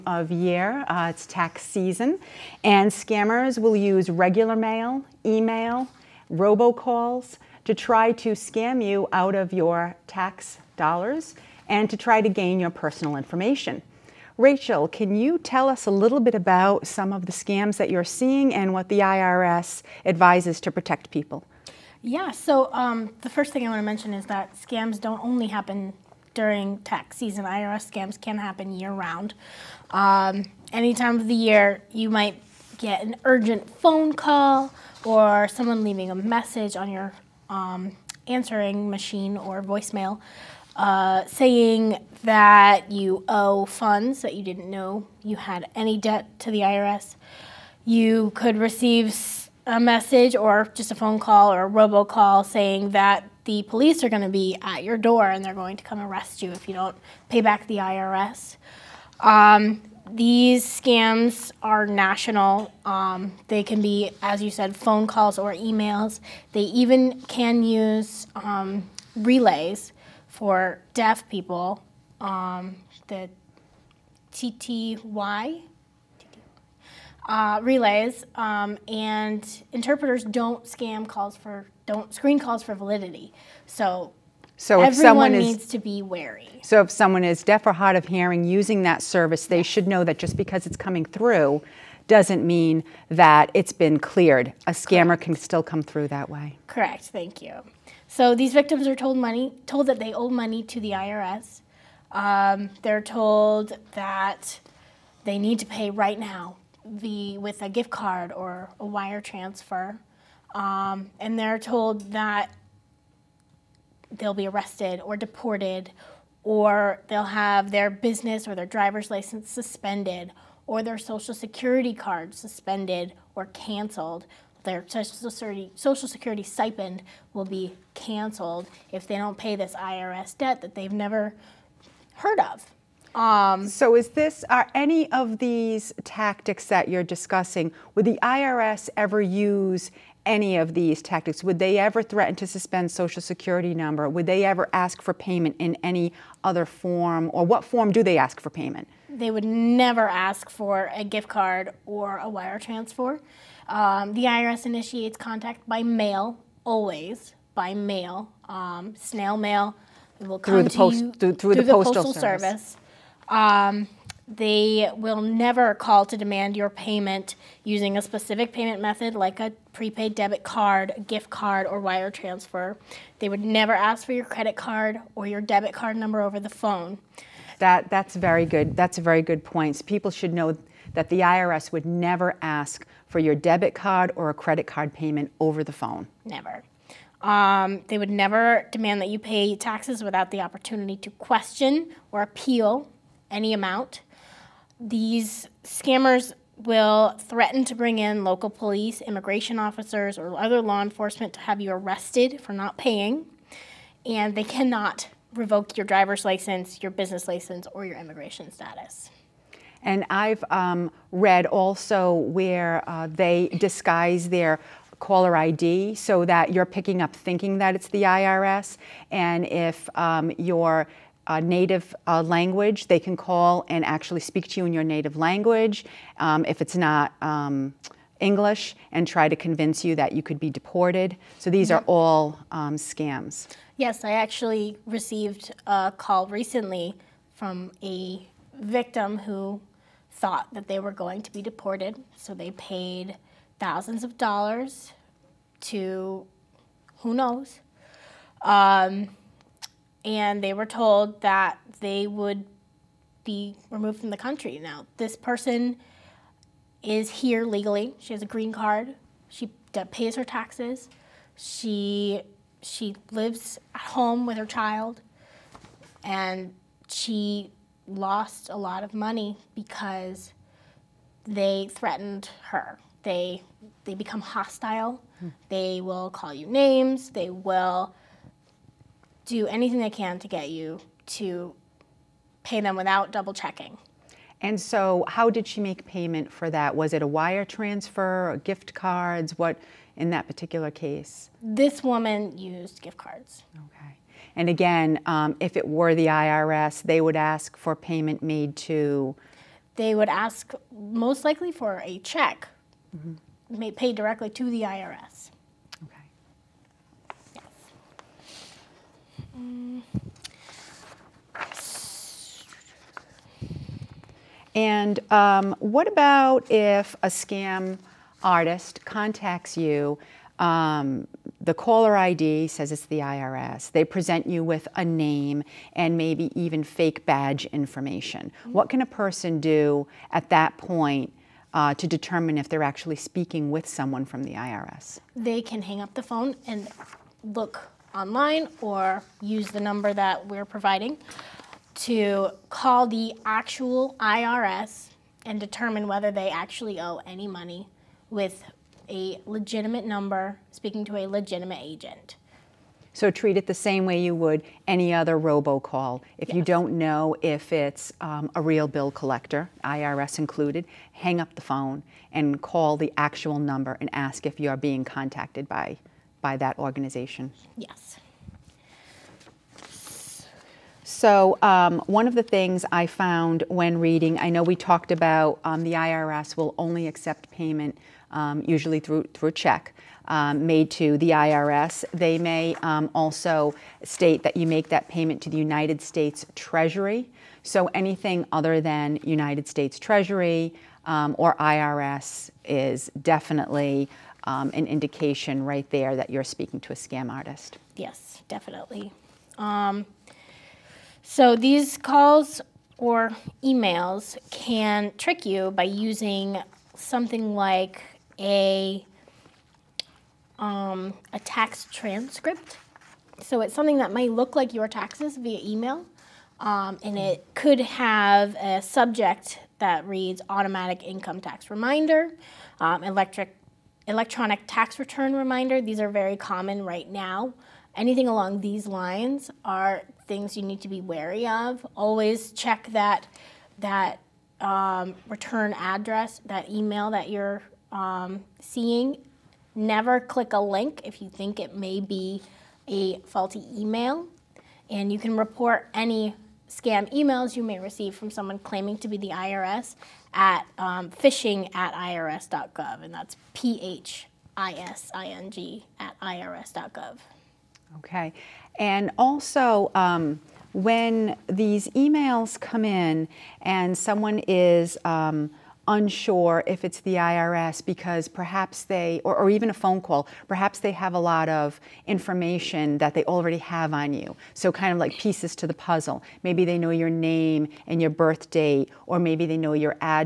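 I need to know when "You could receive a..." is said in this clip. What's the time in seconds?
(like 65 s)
47 s.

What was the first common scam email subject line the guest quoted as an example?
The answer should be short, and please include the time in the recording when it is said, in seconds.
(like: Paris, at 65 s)
Automatic income tax reminder, at 420 s.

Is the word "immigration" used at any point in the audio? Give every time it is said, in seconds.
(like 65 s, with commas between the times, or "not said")
199 s, 207 s.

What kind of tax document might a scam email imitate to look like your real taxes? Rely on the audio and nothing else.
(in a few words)
A tax transcript.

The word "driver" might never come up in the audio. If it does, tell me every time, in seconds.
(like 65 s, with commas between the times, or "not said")
118 s, 205 s.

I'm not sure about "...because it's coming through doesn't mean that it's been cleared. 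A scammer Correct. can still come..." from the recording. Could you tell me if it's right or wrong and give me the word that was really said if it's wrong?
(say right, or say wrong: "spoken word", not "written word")
right.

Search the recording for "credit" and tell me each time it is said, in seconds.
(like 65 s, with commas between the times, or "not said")
174 s, 184 s.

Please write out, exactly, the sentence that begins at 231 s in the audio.
So these are all um, scams.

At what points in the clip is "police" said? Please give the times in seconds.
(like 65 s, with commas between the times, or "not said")
53 s, 198 s.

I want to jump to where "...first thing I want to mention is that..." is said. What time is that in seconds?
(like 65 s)
23 s.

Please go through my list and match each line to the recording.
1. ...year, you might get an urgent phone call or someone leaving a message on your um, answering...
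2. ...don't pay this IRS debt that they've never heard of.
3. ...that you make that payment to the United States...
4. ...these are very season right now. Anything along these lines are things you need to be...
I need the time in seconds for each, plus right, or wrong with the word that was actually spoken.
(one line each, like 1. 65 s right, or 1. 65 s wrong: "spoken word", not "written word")
1. 31 s right
2. 129 s right
3. 384 s right
4. 425 s wrong: "common", not "season".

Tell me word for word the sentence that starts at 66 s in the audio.
They even can use um, relays for deaf people.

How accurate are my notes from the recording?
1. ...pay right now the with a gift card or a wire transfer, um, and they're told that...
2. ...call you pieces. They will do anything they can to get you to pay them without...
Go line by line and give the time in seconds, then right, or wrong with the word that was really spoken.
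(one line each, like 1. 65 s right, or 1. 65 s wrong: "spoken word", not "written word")
1. 105 s right
2. 276 s wrong: "names", not "pieces".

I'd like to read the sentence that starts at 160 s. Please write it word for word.
It will come through the, post, to you, through, through, through the, the postal, postal, service.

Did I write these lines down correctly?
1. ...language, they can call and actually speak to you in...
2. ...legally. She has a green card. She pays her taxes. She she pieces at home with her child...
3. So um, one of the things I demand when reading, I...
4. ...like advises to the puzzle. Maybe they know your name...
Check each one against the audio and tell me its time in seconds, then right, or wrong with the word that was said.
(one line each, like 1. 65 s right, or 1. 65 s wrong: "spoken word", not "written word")
1. 222 s right
2. 257 s wrong: "lives", not "pieces"
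3. 370 s wrong: "found", not "demand"
4. 474 s wrong: "pieces", not "advises".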